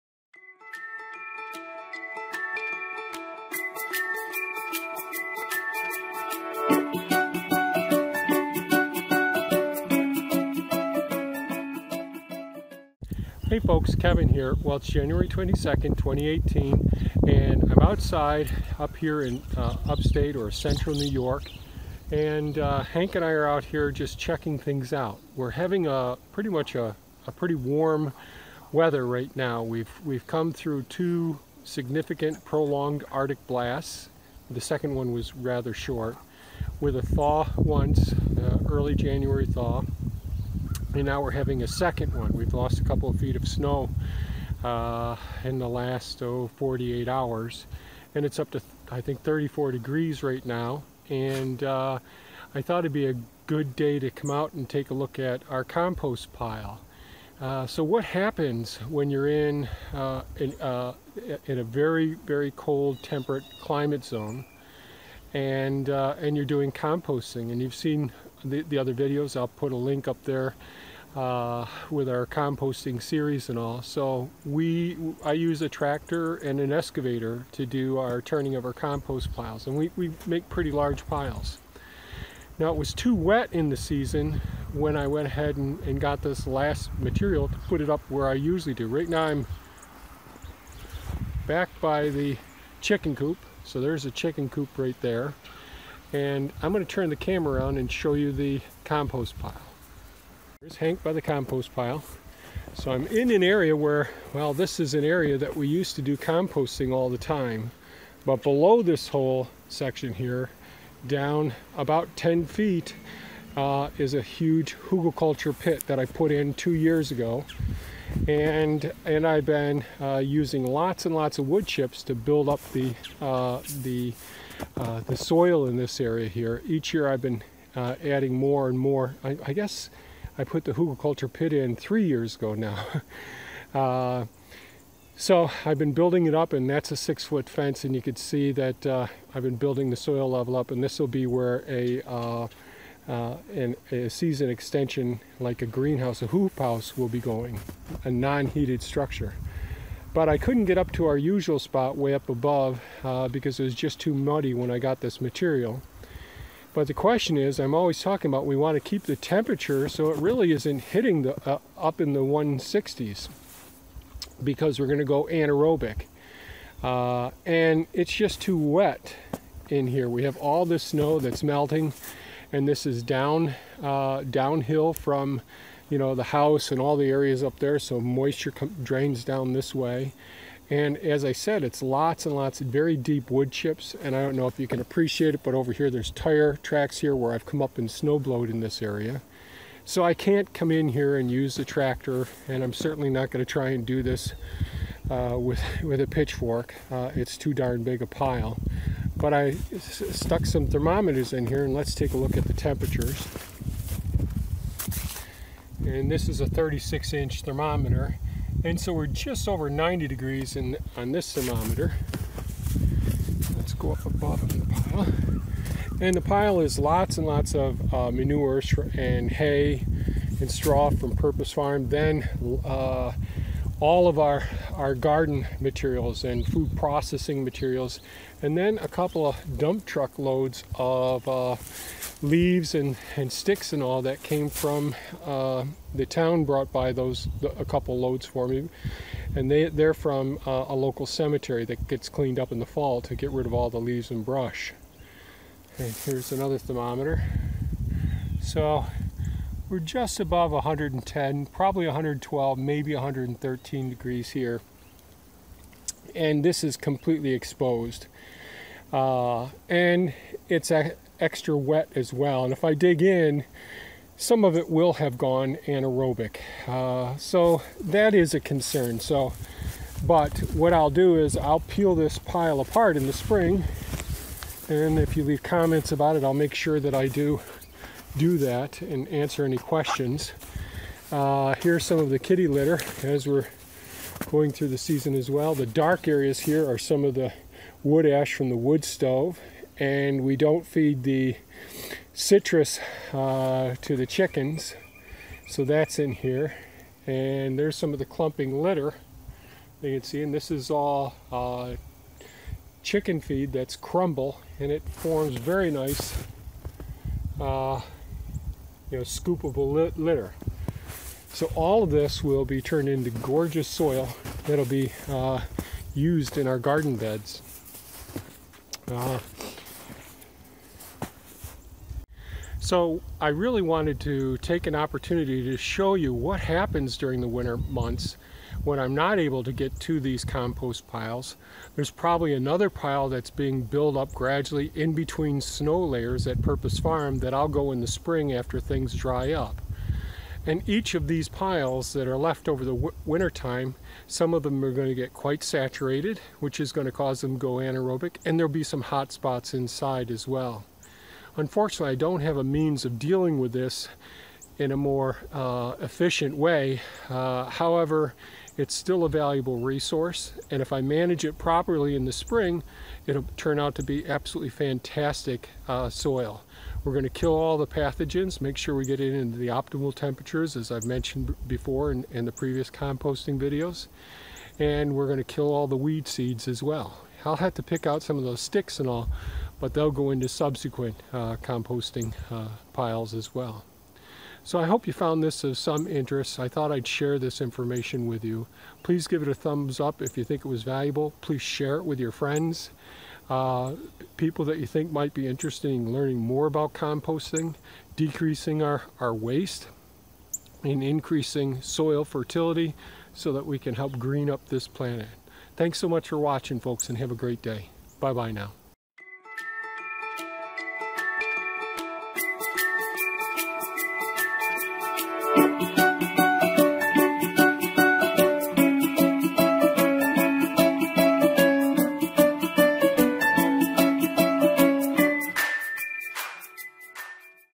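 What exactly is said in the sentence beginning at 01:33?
So there's a chicken coop right there and I'm going to turn the camera around and show you the compost pile.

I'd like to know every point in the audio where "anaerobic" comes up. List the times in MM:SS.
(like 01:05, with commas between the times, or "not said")
02:45, 04:25, 05:47.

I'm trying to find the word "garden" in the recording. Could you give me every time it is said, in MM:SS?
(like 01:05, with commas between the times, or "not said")
03:44, 05:16.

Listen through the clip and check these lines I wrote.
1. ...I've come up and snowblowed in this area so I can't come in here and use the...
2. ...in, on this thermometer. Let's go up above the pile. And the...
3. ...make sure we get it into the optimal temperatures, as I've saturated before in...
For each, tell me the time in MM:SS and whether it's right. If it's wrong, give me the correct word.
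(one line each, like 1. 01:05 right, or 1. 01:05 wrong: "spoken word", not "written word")
1. 03:07 right
2. 03:30 right
3. 06:08 wrong: "mentioned", not "saturated".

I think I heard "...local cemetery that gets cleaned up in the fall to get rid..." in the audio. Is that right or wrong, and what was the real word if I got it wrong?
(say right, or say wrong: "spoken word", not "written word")
right.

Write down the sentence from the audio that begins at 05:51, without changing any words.
Unfortunately, I don't have a means of dealing with this in a more uh, efficient way.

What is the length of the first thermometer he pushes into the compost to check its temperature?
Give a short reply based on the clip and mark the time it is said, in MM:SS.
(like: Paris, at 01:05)
36 inches, at 03:26.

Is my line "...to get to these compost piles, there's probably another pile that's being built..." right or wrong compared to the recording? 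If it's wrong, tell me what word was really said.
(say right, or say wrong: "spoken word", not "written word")
right.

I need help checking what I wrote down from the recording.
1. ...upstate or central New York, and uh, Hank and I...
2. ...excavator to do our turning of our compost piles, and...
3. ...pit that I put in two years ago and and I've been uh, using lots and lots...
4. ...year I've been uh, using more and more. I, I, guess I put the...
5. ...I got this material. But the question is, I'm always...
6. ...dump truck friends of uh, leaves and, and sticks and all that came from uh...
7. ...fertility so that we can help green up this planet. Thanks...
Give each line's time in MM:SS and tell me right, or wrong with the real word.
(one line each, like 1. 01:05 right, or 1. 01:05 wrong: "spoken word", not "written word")
1. 00:19 right
2. 01:16 right
3. 01:55 right
4. 02:06 wrong: "adding", not "using"
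5. 02:34 right
6. 03:49 wrong: "loads", not "friends"
7. 06:42 right.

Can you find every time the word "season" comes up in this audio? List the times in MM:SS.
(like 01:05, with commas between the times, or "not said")
01:23, 02:24, 04:44.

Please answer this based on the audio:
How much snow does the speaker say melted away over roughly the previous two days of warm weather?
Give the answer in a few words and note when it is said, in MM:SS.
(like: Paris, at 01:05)
a couple of feet, at 00:42.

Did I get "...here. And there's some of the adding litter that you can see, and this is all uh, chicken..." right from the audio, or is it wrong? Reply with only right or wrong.
wrong.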